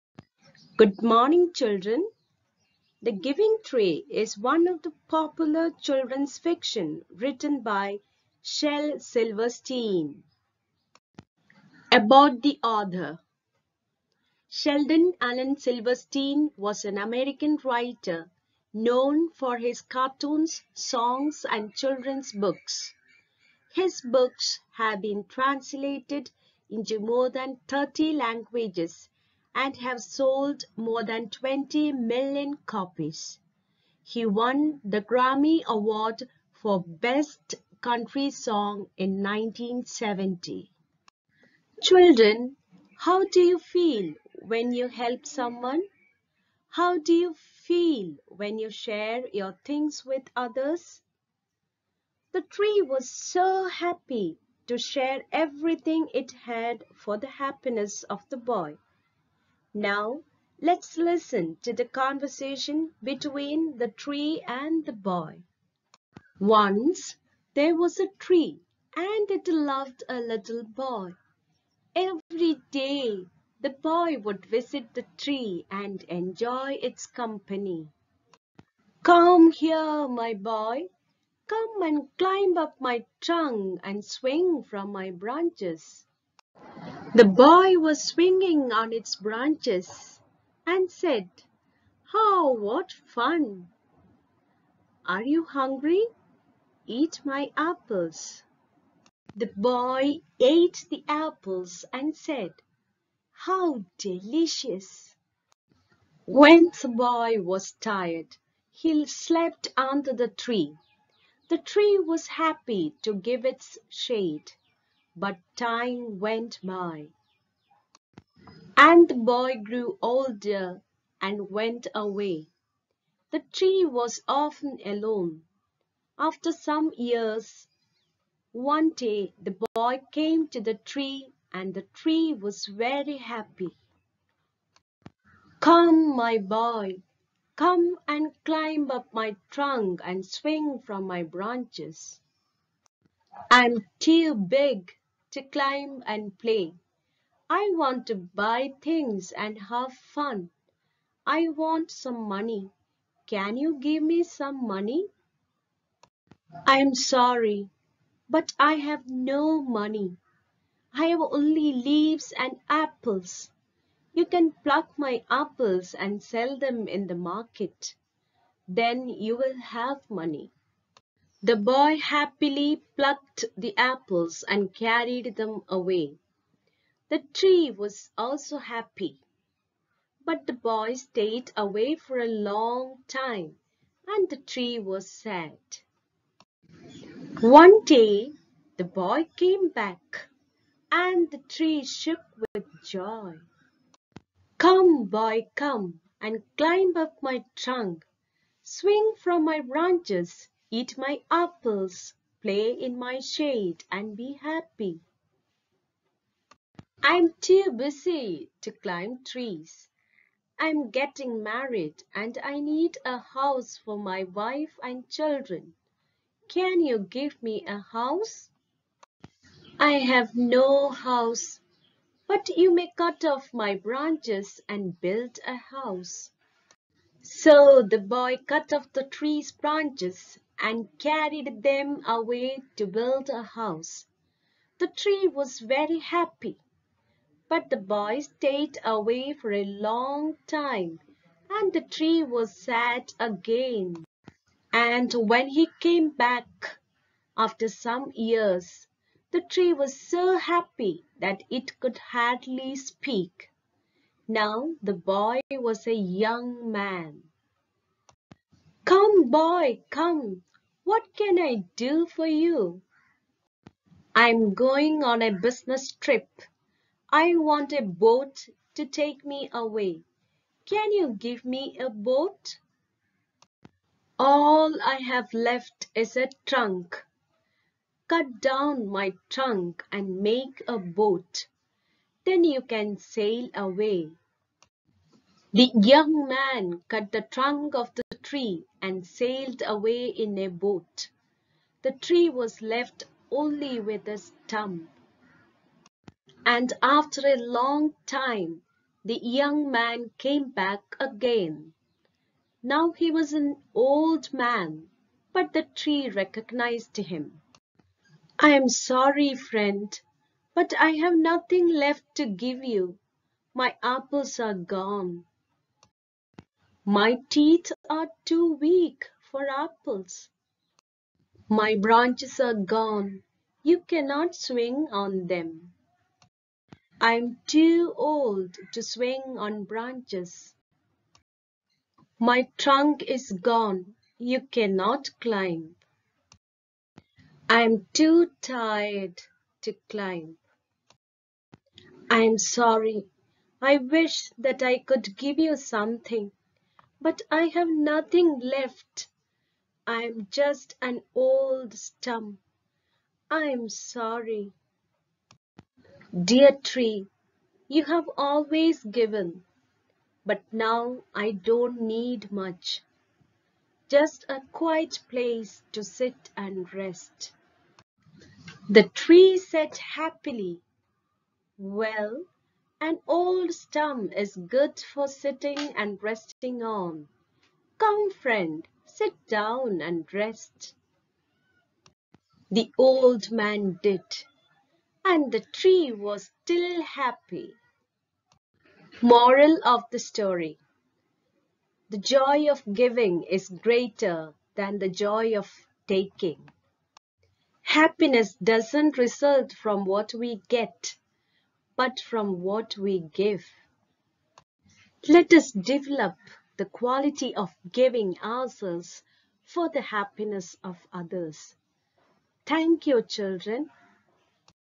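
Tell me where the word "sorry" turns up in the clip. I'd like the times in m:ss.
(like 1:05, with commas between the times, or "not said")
2:36, 5:08, 5:42, 5:53.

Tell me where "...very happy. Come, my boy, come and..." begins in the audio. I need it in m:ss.
2:12.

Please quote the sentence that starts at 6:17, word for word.
Come, friend, sit down and rest.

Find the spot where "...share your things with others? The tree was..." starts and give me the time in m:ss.
0:48.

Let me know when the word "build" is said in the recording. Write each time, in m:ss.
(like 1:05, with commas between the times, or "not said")
3:45, 3:52.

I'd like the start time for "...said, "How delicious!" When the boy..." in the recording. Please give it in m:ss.
1:42.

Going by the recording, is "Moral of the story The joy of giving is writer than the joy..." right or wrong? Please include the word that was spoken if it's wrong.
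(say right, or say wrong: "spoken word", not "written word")
wrong: "greater", not "writer".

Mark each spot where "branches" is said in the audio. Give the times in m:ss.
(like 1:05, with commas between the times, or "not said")
1:25, 1:29, 2:21, 3:19, 3:43, 3:49, 5:21, 5:29.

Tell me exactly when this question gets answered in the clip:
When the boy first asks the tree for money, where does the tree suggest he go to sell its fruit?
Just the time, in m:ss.
2:47.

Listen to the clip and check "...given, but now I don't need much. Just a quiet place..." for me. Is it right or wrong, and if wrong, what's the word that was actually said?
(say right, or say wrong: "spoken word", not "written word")
right.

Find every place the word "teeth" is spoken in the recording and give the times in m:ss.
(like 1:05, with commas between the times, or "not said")
5:17.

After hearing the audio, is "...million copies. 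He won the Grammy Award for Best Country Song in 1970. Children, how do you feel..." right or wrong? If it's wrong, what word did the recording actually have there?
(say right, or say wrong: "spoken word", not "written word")
right.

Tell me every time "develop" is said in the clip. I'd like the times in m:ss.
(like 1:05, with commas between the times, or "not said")
6:45.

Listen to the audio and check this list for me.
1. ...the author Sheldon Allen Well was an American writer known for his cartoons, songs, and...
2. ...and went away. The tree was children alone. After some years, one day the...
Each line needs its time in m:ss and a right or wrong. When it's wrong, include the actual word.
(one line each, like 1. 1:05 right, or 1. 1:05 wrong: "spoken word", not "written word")
1. 0:12 wrong: "Silverstein", not "Well"
2. 2:01 wrong: "often", not "children".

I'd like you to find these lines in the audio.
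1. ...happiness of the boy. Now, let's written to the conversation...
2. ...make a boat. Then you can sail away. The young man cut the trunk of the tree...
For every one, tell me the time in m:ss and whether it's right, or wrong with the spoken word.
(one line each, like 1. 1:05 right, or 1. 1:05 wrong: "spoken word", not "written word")
1. 0:57 wrong: "listen", not "written"
2. 4:40 right.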